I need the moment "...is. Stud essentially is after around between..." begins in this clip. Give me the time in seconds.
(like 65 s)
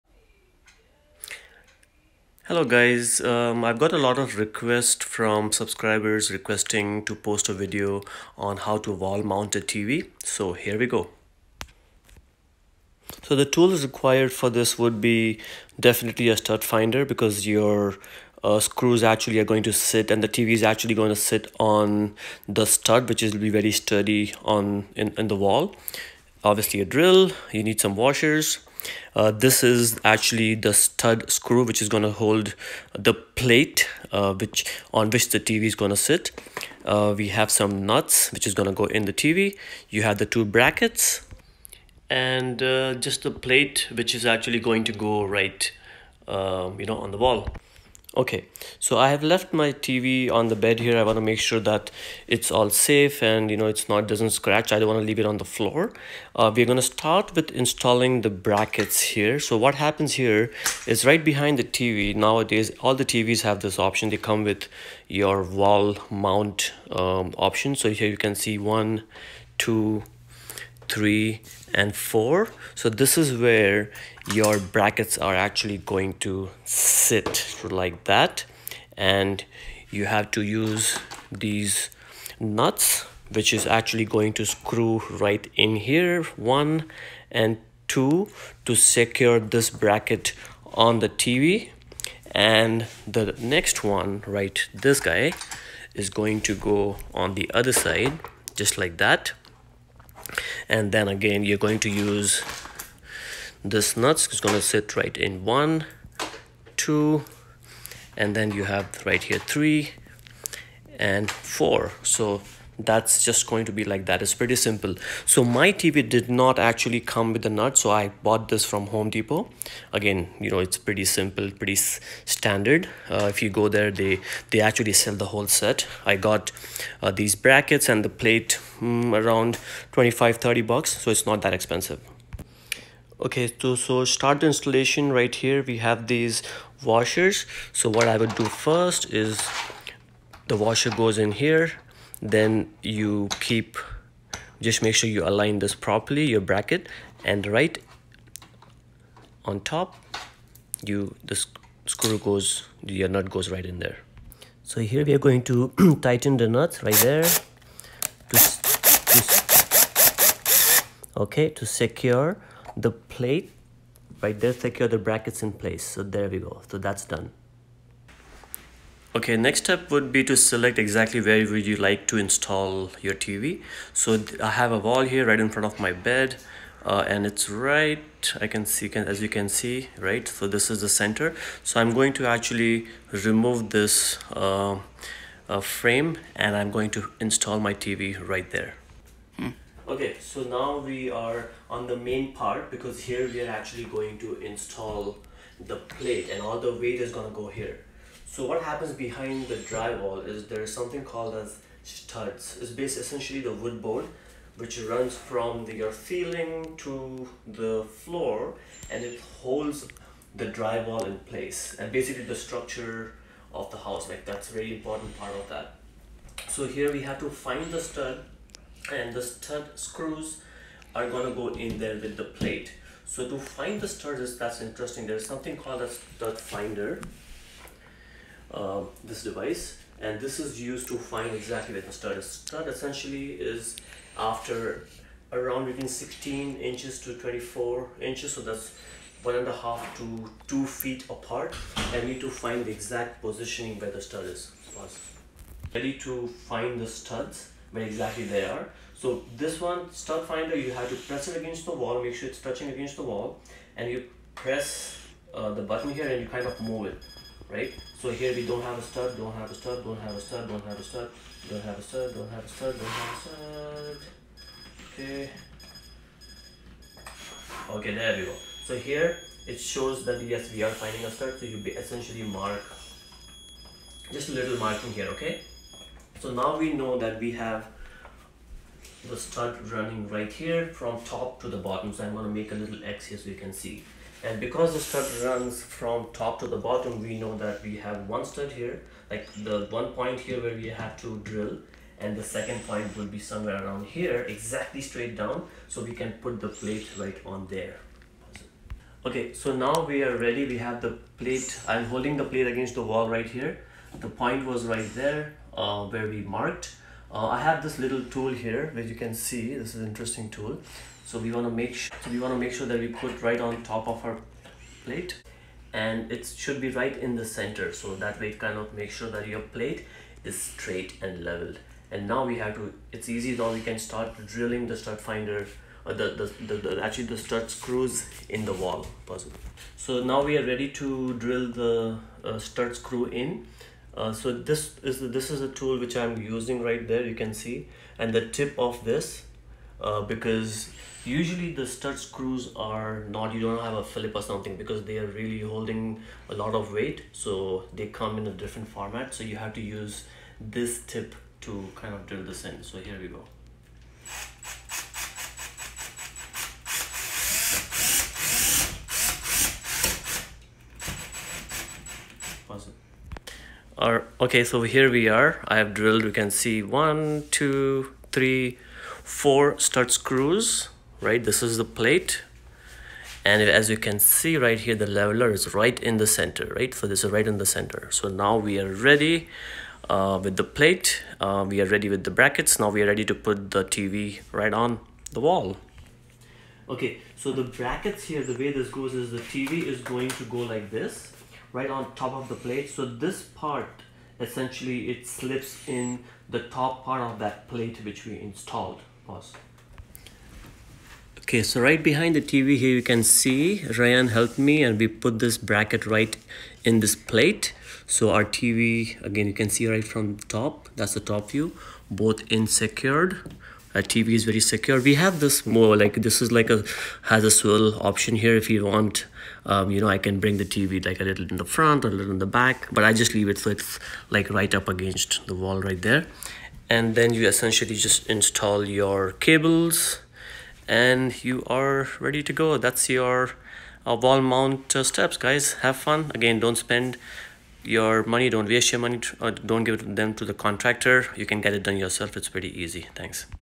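232 s.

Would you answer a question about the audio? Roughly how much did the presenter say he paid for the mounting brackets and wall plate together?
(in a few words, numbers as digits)
25-30 bucks.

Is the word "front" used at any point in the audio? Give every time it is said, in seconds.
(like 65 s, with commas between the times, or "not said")
175 s, 421 s.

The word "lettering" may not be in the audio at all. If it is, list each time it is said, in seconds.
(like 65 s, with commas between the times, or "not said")
not said.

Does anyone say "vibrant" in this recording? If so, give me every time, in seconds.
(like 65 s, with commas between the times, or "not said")
not said.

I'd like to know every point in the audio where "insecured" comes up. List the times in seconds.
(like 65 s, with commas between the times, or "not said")
412 s.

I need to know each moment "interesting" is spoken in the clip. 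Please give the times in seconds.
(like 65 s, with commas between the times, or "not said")
224 s, 309 s.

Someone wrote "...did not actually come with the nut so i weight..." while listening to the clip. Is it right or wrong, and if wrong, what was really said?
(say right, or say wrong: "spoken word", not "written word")
wrong: "bought", not "weight".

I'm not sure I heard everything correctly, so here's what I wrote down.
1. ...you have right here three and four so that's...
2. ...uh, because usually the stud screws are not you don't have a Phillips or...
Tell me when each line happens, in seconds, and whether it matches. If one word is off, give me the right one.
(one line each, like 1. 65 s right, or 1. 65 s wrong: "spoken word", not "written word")
1. 108 s right
2. 339 s right.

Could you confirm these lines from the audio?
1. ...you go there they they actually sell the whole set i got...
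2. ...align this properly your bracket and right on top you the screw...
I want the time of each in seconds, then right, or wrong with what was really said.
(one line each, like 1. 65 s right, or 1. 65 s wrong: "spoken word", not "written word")
1. 123 s right
2. 145 s right.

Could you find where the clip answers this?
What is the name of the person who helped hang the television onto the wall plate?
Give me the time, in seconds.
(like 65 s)
403 s.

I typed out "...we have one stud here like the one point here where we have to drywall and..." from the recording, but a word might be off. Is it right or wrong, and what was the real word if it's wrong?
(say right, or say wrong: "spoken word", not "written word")
wrong: "drill", not "drywall".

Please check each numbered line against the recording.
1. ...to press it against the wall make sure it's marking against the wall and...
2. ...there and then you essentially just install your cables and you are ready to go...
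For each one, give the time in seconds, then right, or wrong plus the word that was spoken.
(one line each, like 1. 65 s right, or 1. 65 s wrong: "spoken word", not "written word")
1. 250 s wrong: "touching", not "marking"
2. 425 s right.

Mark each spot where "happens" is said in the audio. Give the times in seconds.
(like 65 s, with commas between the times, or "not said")
59 s, 198 s.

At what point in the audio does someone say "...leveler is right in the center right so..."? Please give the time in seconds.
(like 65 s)
374 s.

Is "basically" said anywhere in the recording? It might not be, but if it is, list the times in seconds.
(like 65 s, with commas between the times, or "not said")
202 s, 211 s.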